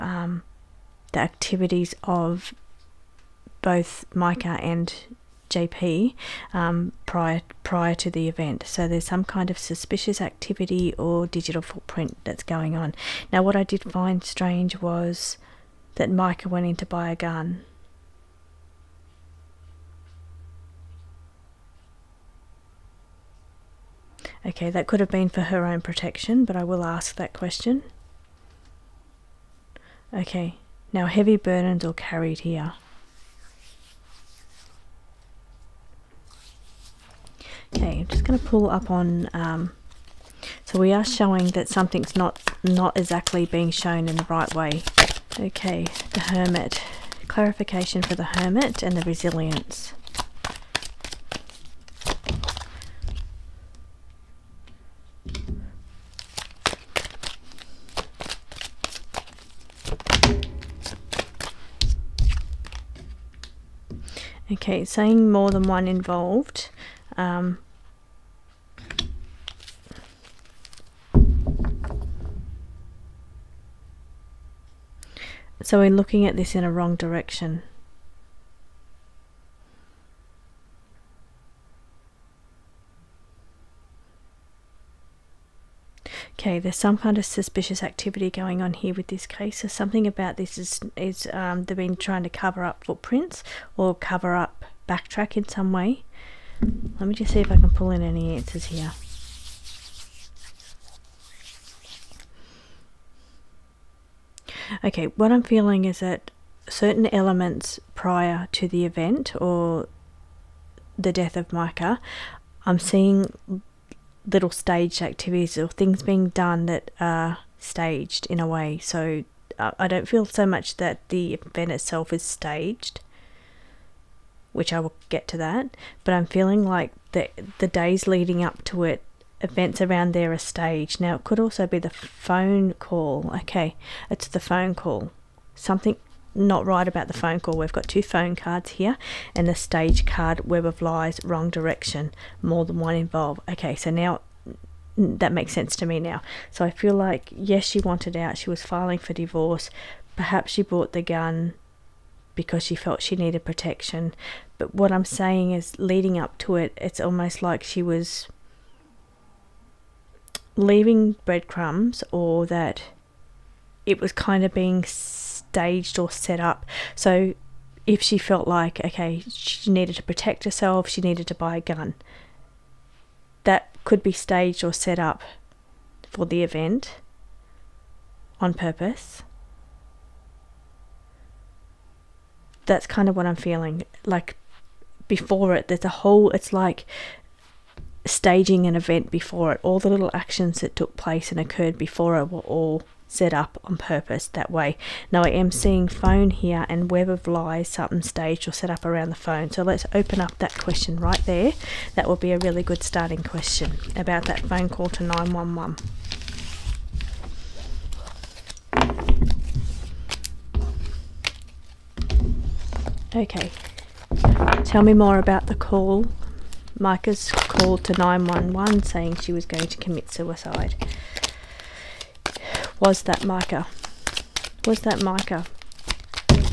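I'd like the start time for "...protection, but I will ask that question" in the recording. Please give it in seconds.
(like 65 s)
25 s.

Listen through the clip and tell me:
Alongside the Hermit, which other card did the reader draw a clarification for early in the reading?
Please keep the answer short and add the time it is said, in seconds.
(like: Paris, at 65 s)
Resilience, at 49 s.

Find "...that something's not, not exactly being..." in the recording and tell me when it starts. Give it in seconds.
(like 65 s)
41 s.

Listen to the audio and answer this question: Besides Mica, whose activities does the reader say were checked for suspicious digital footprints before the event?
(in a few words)
JP.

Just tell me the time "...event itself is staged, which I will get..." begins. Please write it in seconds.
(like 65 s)
121 s.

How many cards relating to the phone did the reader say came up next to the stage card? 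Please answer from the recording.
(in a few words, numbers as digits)
2.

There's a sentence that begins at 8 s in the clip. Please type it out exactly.
So there's some kind of suspicious activity or digital footprint that's going on.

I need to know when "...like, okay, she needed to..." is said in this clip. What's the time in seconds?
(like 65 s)
168 s.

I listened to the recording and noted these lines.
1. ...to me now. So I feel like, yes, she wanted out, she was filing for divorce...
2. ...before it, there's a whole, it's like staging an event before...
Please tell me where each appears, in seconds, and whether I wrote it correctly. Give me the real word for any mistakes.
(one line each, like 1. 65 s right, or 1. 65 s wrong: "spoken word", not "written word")
1. 145 s right
2. 185 s right.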